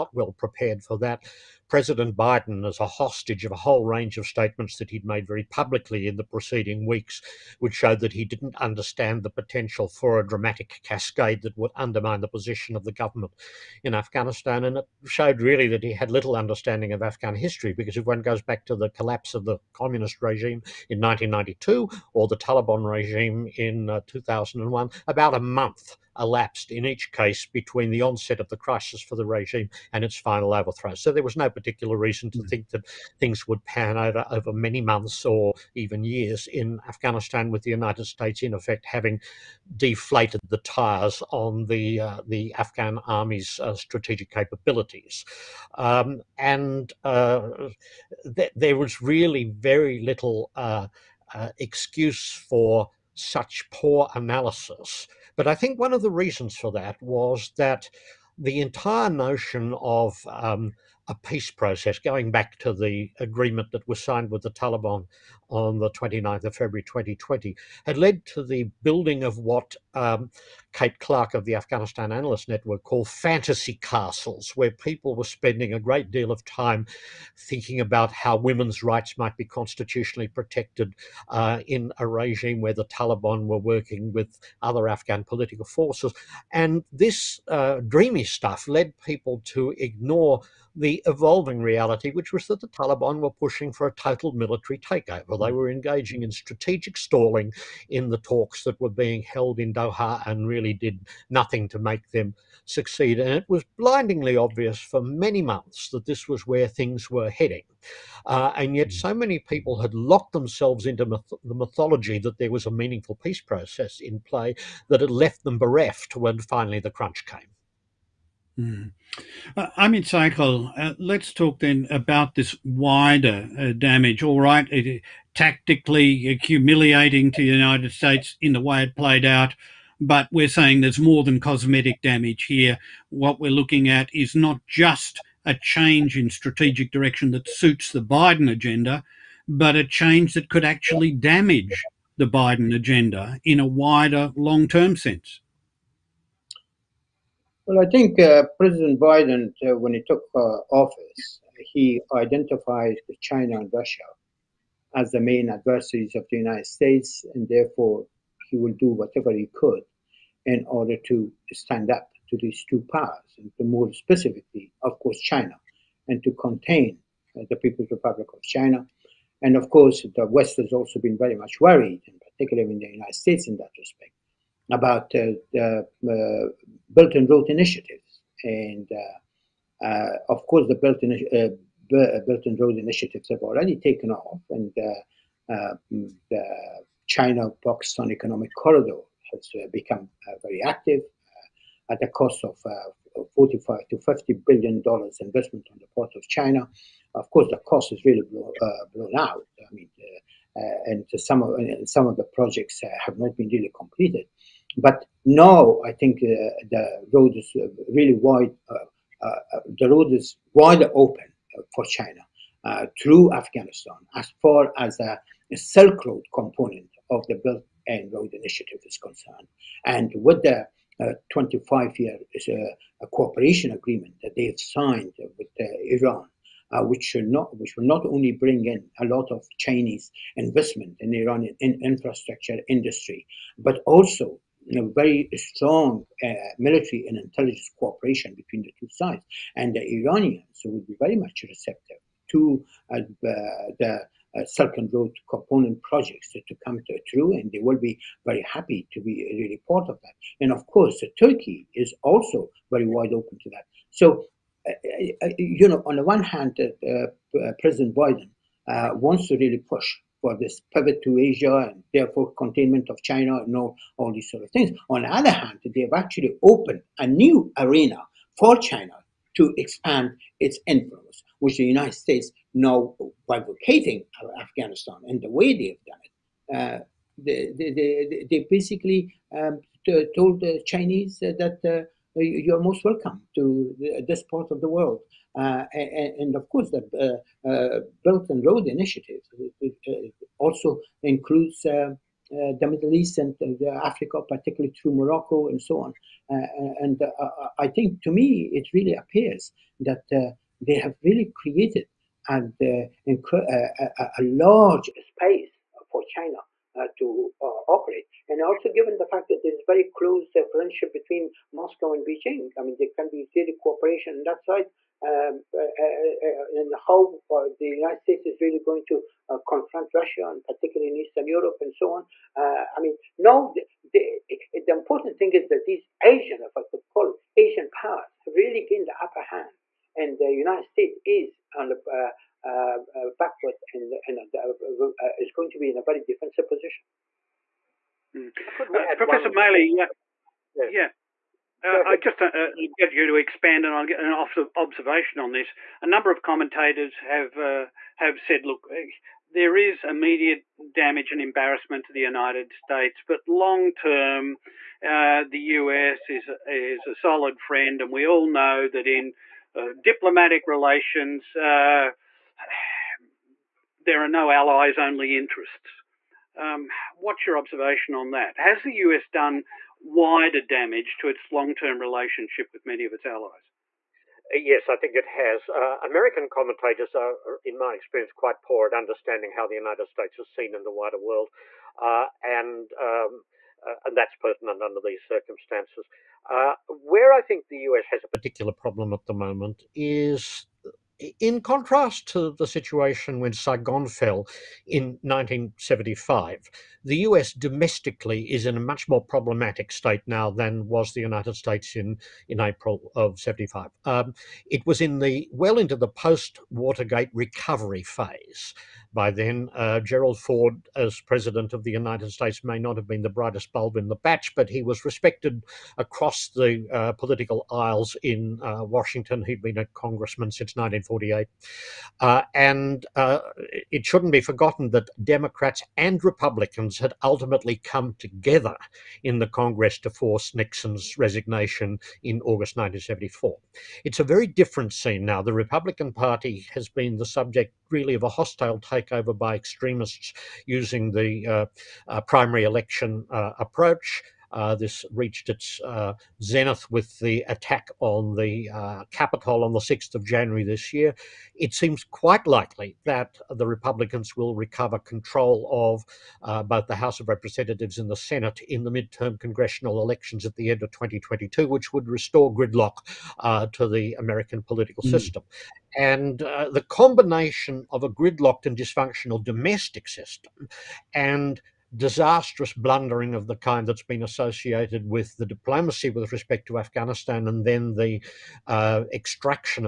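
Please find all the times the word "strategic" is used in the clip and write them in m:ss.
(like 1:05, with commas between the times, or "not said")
0:43, 1:36, 2:16.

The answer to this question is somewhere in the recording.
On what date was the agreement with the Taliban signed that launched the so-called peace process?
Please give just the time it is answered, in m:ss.
1:05.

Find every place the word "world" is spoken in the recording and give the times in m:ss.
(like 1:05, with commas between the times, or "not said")
4:44, 6:20.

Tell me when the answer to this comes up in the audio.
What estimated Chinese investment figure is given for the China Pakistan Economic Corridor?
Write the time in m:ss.
3:13.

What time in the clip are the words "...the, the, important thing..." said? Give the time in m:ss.
5:24.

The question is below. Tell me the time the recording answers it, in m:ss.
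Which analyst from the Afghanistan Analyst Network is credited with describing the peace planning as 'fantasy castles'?
1:10.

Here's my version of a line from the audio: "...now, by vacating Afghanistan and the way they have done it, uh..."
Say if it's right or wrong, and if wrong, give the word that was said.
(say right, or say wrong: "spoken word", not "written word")
right.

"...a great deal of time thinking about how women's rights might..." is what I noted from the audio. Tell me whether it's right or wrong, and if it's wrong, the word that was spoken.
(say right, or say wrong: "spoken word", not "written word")
right.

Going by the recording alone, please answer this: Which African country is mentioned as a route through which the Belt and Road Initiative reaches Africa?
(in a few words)
Morocco.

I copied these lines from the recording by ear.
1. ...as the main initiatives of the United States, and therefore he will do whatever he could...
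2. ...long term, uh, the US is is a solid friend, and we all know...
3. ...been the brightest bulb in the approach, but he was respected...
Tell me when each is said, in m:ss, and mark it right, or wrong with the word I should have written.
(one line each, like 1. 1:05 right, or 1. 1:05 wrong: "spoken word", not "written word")
1. 2:34 wrong: "adversaries", not "initiatives"
2. 5:53 right
3. 6:52 wrong: "batch", not "approach".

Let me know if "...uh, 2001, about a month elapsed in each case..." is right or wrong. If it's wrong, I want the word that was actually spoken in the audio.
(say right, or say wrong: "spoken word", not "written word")
right.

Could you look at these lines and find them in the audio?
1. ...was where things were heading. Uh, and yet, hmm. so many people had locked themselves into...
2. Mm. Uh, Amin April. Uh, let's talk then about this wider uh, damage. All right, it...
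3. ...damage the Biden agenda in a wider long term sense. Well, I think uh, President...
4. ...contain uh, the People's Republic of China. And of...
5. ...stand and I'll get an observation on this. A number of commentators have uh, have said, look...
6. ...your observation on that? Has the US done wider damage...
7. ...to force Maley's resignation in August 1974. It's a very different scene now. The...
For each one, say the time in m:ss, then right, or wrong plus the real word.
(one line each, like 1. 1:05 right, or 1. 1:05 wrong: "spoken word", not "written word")
1. 1:46 right
2. 1:58 wrong: "Saikal", not "April"
3. 2:21 right
4. 2:46 right
5. 5:43 wrong: "expand", not "stand"
6. 6:07 right
7. 7:09 wrong: "Nixon", not "Maley".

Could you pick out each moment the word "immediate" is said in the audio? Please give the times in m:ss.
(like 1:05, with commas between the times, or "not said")
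5:49.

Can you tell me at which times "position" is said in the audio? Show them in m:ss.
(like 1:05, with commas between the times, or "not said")
0:12, 5:36.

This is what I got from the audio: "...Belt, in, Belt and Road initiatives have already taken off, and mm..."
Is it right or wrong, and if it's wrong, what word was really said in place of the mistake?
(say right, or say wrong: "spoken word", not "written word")
right.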